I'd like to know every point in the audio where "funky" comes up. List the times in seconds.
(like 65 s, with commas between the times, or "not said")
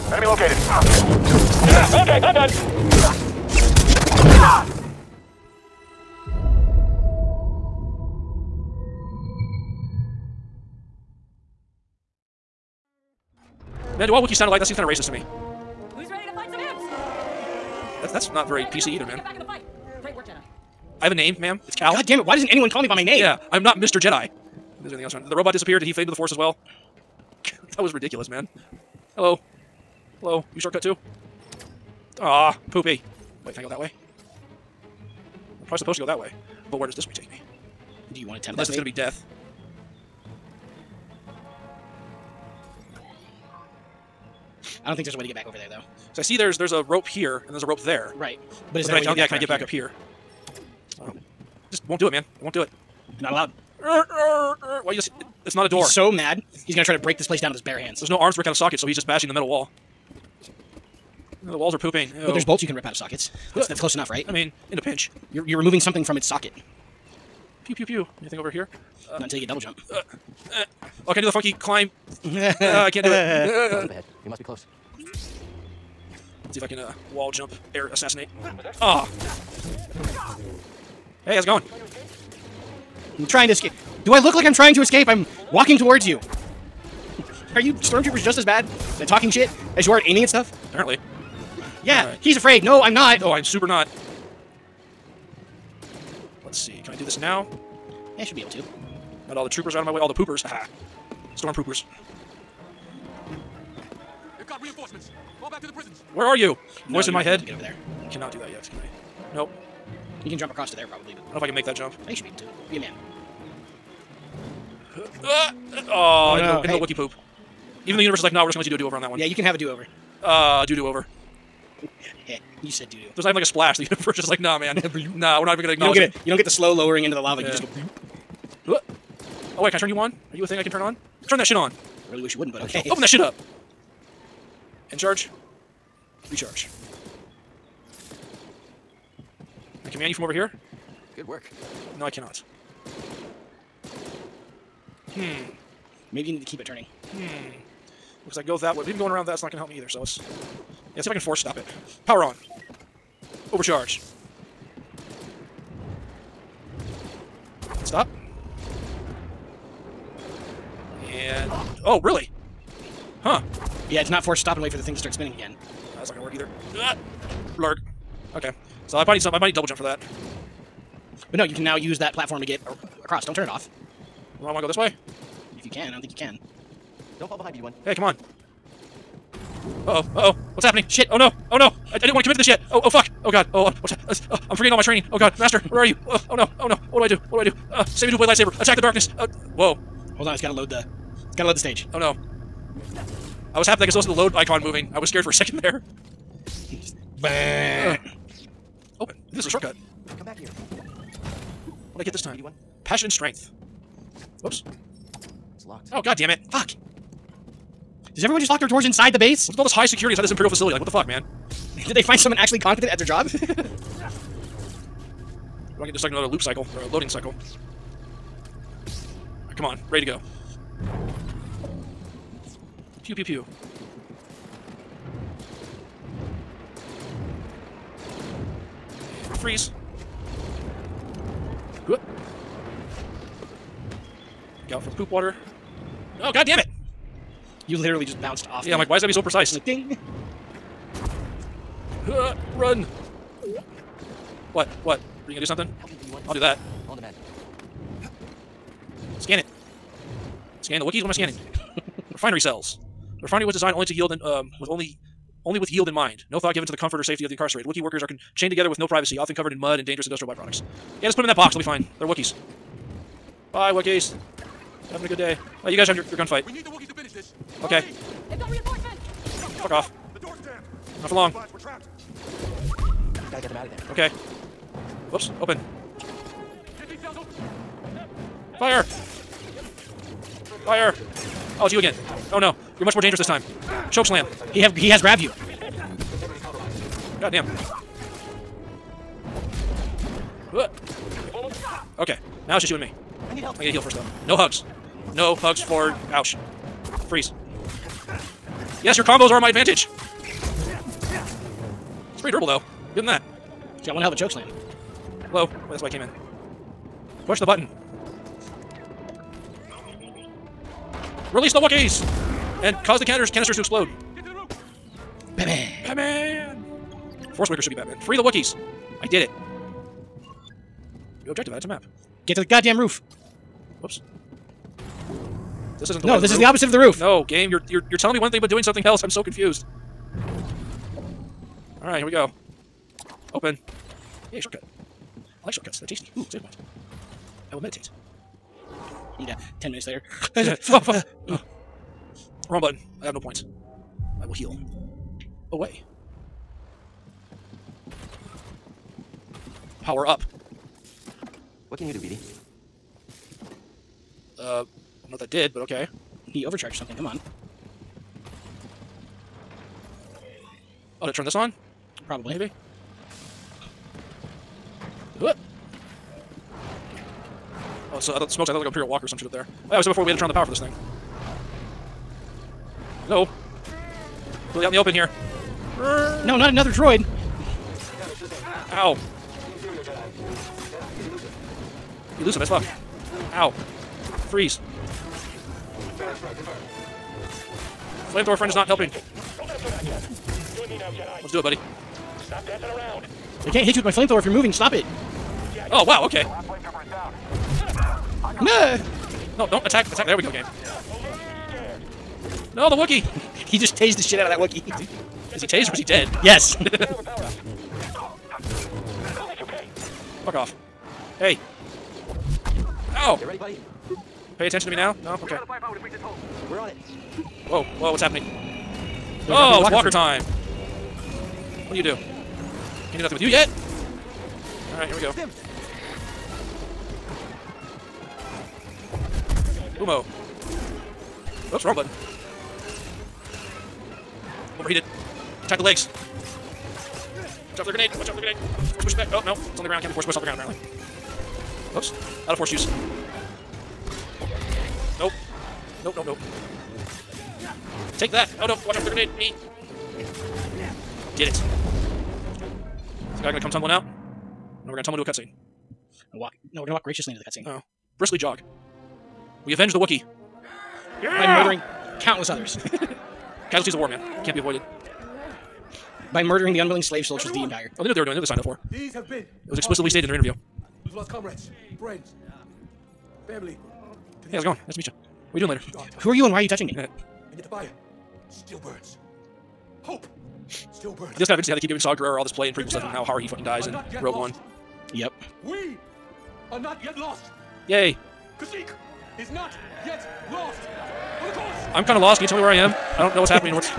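71 s.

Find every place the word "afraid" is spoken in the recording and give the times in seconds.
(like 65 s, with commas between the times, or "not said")
92 s.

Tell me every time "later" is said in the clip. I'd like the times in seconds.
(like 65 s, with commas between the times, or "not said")
339 s, 475 s.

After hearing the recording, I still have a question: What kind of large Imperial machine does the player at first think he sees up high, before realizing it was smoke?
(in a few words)
Imperial Walker.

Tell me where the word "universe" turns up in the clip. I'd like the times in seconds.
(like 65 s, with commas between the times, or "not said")
118 s, 123 s.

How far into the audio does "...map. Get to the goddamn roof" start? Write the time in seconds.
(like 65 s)
321 s.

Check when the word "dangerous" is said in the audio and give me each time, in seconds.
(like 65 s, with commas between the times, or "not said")
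259 s, 282 s.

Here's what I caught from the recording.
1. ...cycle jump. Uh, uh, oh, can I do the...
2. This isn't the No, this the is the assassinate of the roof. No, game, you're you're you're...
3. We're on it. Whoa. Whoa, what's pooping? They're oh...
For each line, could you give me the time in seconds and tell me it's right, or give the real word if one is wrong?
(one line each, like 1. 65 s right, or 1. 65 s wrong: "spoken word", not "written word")
1. 69 s wrong: "double", not "cycle"
2. 325 s wrong: "opposite", not "assassinate"
3. 416 s wrong: "happening", not "pooping".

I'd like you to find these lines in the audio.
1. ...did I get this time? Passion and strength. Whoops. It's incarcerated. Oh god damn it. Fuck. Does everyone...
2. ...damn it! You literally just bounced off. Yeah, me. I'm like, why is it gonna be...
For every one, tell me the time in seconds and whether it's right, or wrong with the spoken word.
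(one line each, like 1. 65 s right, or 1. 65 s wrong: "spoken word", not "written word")
1. 201 s wrong: "locked", not "incarcerated"
2. 236 s right.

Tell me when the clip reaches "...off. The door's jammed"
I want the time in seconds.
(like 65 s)
269 s.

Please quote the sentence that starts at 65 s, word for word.
You're, you're removing something from its socket.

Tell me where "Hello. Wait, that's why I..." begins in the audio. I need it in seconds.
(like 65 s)
305 s.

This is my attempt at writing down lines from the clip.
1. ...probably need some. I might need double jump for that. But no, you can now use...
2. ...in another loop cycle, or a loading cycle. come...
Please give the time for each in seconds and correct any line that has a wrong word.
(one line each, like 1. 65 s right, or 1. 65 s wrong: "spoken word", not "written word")
1. 169 s right
2. 216 s right.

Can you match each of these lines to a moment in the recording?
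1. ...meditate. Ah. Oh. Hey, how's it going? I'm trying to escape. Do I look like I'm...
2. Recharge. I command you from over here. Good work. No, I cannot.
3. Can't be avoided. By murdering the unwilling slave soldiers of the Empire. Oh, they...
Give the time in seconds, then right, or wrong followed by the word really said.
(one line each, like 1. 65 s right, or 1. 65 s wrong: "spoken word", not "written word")
1. 77 s wrong: "assassinate", not "meditate"
2. 136 s right
3. 464 s right.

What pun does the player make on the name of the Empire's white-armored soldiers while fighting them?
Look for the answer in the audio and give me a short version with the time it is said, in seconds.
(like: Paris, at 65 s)
Storm poopers, at 101 s.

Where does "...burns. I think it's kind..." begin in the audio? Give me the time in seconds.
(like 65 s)
480 s.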